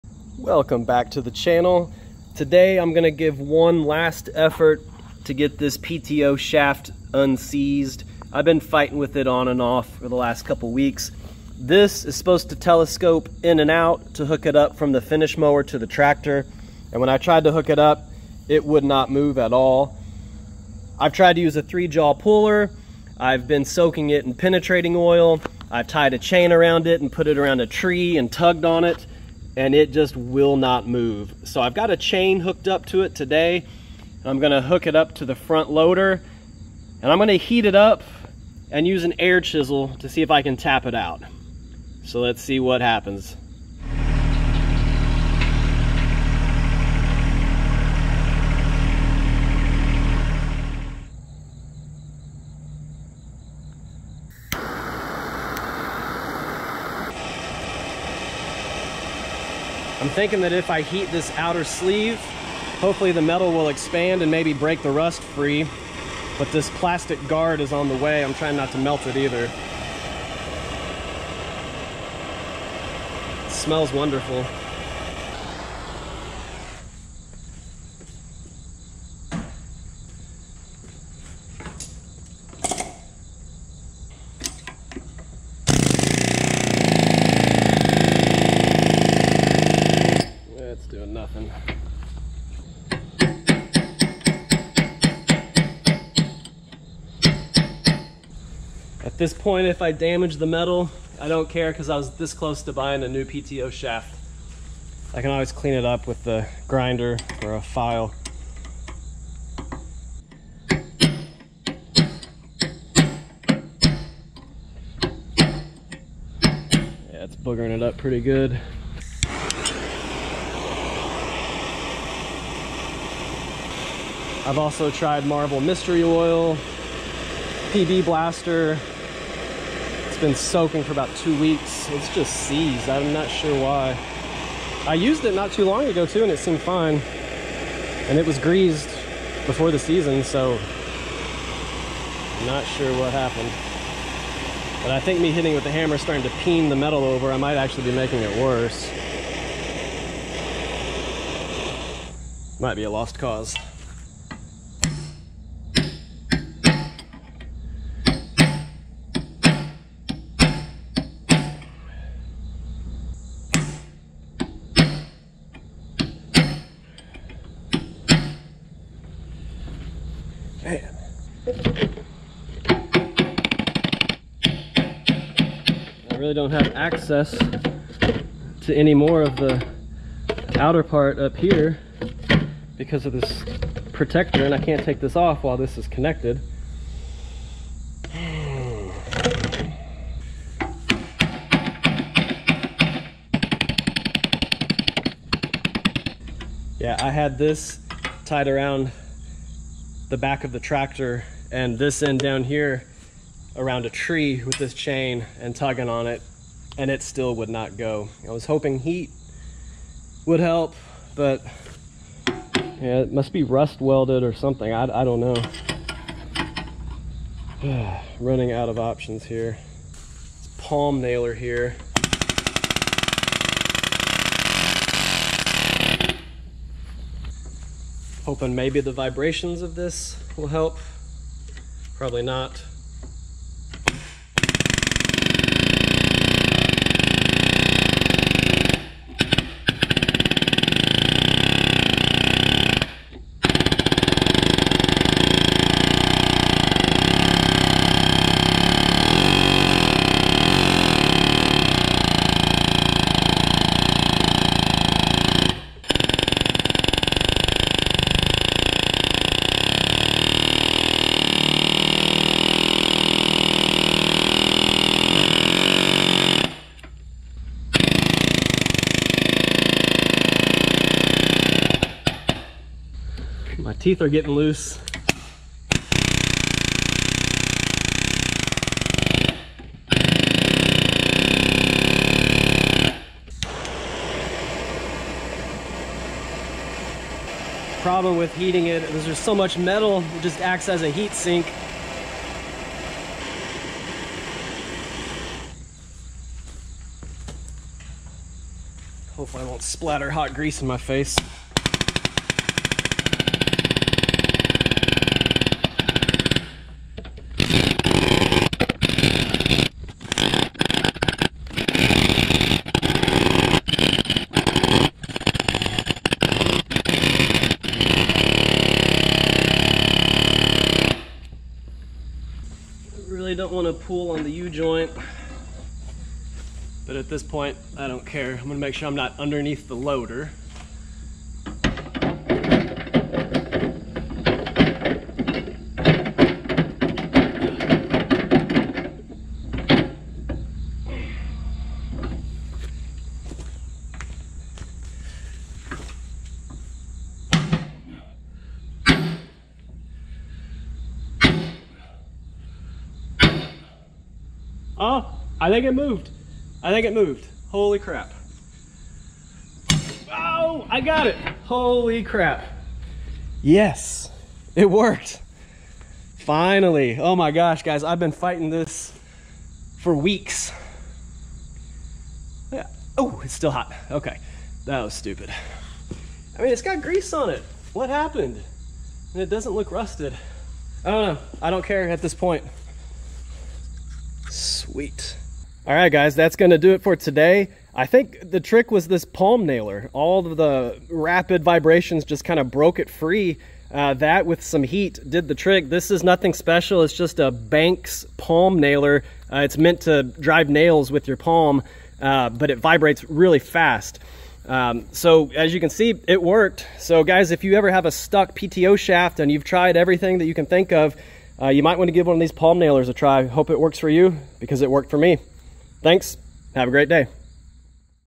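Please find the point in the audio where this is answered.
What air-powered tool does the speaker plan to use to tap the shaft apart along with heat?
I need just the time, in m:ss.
0:39.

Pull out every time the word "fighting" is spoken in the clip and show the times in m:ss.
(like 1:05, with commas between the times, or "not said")
0:08, 6:08.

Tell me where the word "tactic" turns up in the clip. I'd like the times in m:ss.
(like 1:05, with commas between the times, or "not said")
not said.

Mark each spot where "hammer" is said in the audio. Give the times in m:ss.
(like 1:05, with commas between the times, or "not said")
2:25.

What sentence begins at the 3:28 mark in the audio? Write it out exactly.
I was hoping heat would help, but yeah, it must be rust welded or something.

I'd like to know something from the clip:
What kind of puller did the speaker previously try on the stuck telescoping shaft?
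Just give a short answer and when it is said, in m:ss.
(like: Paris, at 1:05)
three jaw puller, at 0:21.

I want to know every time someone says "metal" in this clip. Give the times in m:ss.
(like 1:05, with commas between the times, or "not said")
1:03, 1:40, 2:26, 4:49.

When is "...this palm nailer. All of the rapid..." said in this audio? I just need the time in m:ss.
6:28.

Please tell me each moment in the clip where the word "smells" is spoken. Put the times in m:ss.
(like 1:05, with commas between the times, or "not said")
1:13.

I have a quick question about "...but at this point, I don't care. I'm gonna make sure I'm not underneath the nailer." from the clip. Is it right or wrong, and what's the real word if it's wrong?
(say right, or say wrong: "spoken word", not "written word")
wrong: "loader", not "nailer".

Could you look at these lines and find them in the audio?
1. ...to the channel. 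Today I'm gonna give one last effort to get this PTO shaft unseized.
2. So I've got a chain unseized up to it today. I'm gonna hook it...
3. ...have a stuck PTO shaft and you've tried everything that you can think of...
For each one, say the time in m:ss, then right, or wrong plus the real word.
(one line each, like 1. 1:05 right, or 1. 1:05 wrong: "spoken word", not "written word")
1. 0:01 right
2. 0:31 wrong: "hooked", not "unseized"
3. 6:47 right.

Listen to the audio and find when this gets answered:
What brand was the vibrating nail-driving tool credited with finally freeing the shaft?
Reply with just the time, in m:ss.
6:37.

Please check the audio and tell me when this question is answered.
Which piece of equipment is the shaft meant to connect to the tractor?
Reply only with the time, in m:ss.
0:14.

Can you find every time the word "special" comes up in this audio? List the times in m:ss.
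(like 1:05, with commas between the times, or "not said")
6:36.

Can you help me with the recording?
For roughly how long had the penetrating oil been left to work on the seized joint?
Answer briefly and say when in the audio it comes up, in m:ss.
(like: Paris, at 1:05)
2 weeks, at 2:10.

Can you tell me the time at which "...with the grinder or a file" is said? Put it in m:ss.
1:46.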